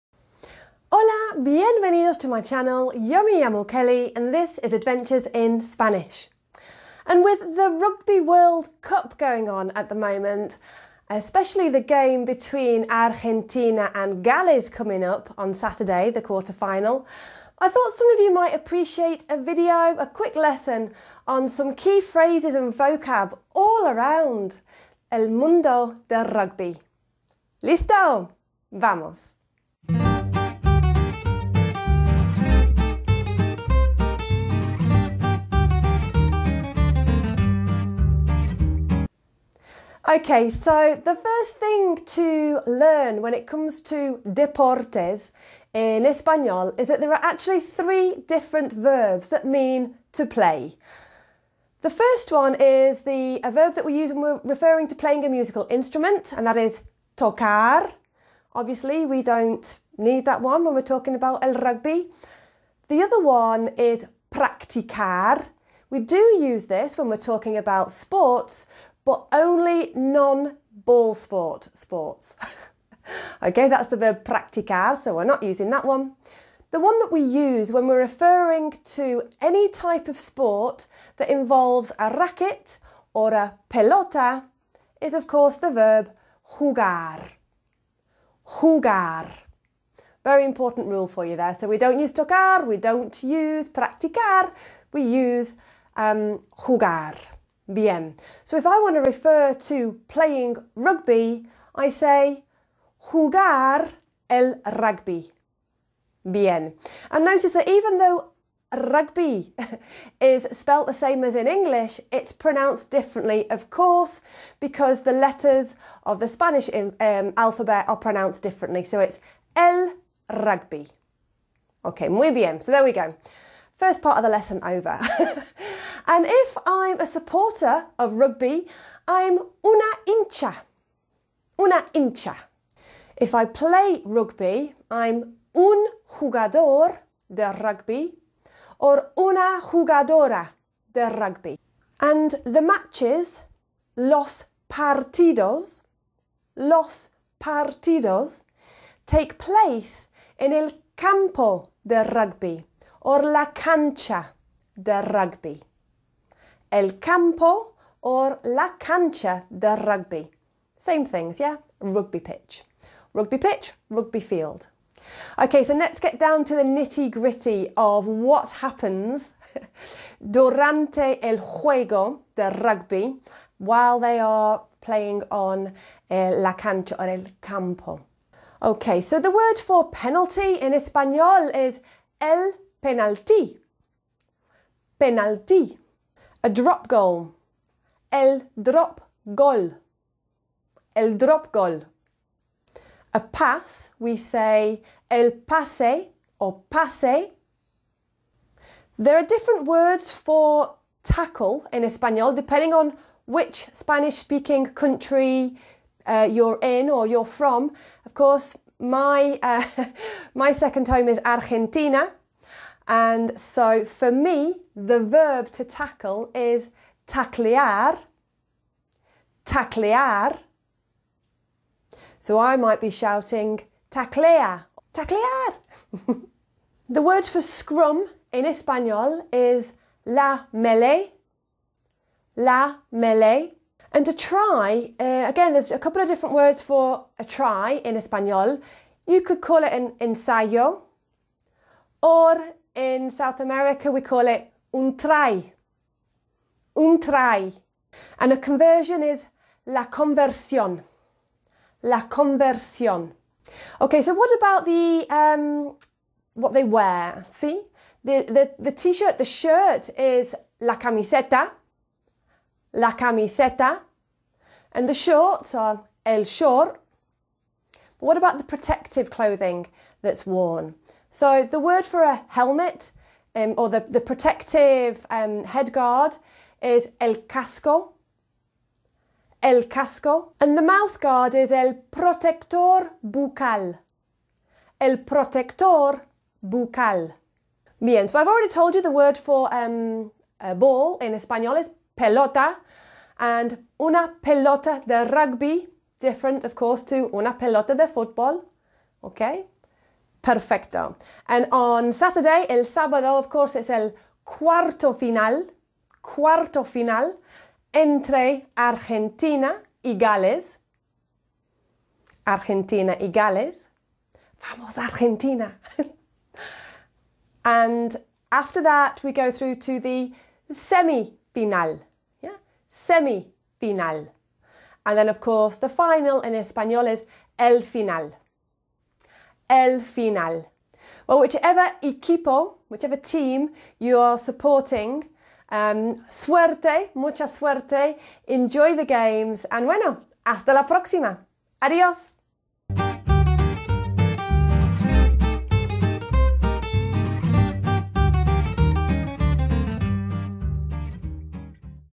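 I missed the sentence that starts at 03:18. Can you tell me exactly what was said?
There are different words for tackle in Espanol depending on which Spanish speaking country uh, you're in or you're from.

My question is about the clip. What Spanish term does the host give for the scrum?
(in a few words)
la melee.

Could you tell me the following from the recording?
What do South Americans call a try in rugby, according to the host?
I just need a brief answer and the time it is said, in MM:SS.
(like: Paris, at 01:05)
un trai, at 04:02.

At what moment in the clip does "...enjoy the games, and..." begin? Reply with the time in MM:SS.
05:38.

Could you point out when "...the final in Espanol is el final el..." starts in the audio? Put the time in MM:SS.
05:25.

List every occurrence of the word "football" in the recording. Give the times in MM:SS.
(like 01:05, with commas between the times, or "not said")
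04:57.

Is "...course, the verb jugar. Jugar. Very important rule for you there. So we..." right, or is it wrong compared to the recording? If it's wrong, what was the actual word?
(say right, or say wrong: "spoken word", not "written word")
right.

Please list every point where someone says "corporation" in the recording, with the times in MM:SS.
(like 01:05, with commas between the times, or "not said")
not said.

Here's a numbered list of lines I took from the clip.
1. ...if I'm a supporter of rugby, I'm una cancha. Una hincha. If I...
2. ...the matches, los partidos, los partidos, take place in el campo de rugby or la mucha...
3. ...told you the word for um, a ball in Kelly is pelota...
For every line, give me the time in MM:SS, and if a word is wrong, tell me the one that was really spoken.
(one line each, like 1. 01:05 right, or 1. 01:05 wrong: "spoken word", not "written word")
1. 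02:06 wrong: "hincha", not "cancha"
2. 02:22 wrong: "cancha", not "mucha"
3. 04:48 wrong: "Espanol", not "Kelly".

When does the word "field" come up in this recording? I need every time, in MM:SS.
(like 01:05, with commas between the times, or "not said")
02:44.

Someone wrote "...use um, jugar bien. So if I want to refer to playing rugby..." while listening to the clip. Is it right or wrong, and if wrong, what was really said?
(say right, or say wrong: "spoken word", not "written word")
right.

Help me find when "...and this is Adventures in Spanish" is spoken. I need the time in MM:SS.
00:04.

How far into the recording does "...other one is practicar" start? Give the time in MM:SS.
01:03.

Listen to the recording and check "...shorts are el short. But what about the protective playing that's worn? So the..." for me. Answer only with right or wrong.
wrong.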